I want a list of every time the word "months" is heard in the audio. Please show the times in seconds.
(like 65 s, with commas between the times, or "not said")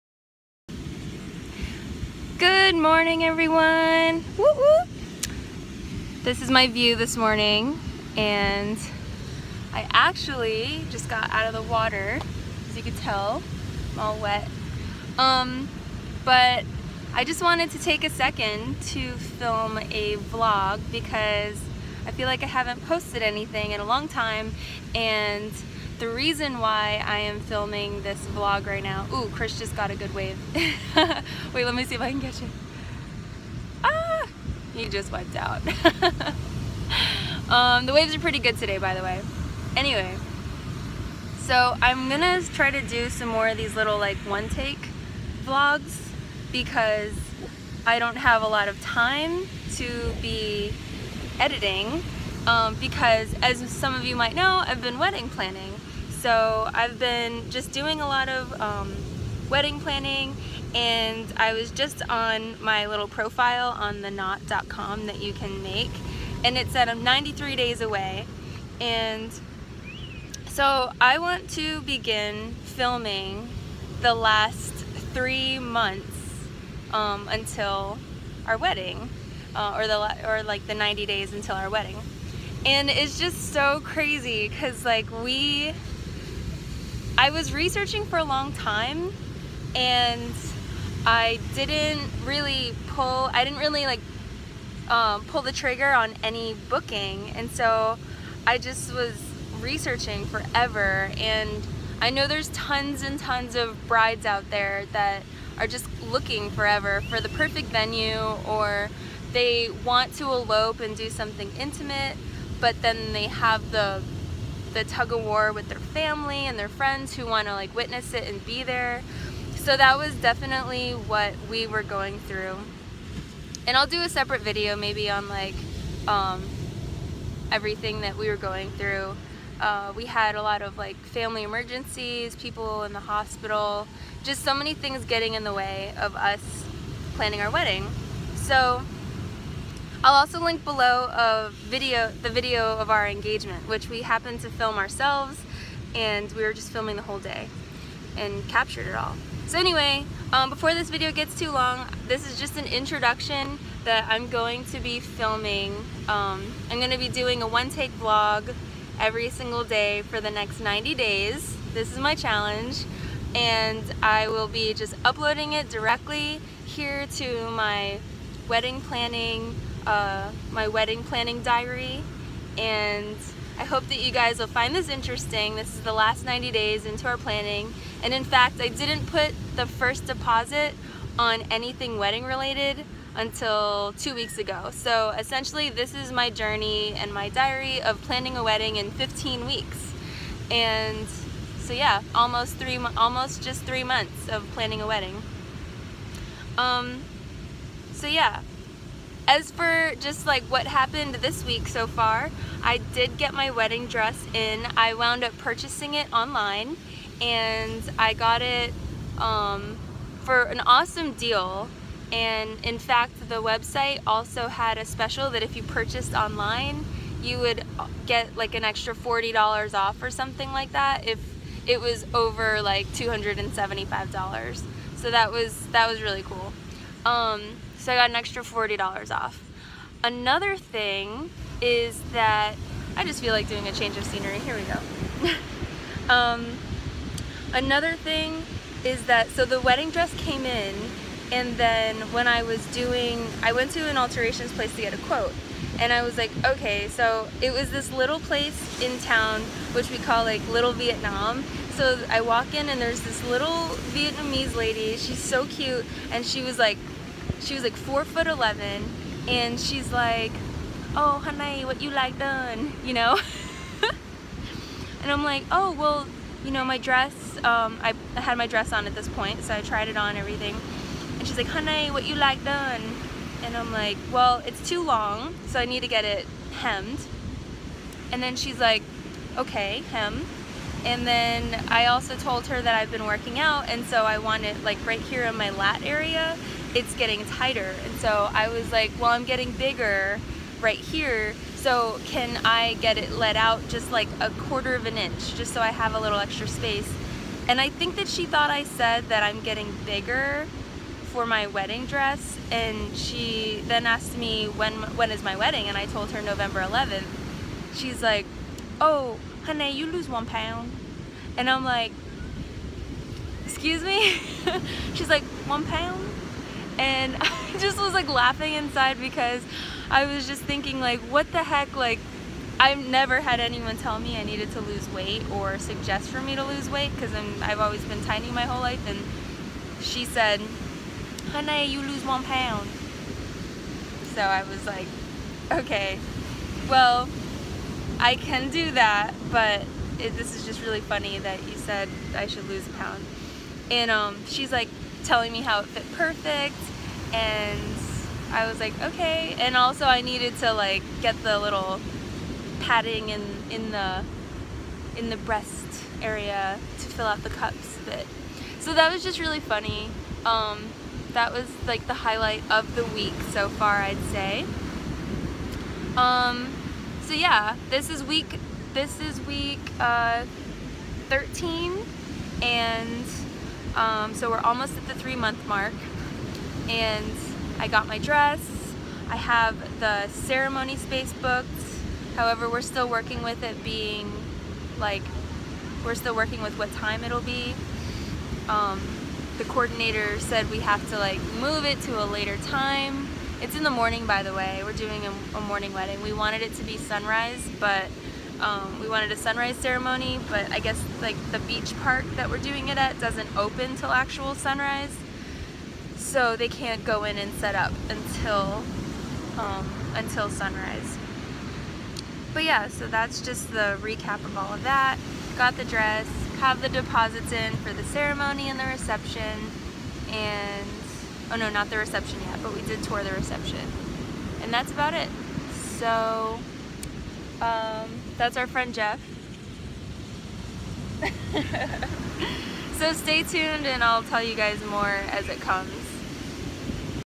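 75 s, 193 s, 375 s.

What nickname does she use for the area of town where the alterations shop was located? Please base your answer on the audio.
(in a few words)
Little Vietnam.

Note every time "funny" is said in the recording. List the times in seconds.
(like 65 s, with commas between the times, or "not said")
340 s, 359 s.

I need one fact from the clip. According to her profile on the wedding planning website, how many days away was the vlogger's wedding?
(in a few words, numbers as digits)
93.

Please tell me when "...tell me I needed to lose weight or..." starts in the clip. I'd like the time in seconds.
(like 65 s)
323 s.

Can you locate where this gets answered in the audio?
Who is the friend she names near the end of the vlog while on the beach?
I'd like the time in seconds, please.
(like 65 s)
428 s.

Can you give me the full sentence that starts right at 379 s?
I have the ceremony space booked.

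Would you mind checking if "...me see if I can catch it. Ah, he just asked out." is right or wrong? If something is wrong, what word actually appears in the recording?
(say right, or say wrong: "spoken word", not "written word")
wrong: "wiped", not "asked".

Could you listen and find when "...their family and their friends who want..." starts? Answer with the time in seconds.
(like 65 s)
115 s.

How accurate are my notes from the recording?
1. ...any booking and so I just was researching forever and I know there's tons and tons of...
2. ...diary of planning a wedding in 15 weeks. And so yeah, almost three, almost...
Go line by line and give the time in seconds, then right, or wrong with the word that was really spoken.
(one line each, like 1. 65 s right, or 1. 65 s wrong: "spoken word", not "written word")
1. 96 s right
2. 187 s right.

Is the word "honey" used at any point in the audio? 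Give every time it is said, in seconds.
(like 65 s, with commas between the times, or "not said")
261 s, 271 s, 309 s, 331 s.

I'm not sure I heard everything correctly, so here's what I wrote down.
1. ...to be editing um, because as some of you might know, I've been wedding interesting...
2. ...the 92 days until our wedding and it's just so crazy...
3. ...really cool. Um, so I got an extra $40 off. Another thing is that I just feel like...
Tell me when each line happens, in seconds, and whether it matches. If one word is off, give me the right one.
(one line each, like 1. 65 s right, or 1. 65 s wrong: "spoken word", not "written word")
1. 49 s wrong: "planning", not "interesting"
2. 80 s wrong: "90", not "92"
3. 226 s right.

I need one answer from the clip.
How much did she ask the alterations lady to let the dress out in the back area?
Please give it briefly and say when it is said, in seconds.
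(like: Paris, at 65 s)
a quarter of an inch, at 294 s.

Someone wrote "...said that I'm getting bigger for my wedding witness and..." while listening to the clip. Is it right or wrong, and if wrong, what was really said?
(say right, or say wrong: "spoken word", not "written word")
wrong: "dress", not "witness".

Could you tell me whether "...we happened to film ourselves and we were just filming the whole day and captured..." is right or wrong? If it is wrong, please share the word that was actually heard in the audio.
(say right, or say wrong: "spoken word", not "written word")
right.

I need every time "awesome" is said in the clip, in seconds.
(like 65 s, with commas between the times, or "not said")
210 s.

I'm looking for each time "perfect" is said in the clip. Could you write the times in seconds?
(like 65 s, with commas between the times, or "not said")
107 s, 345 s.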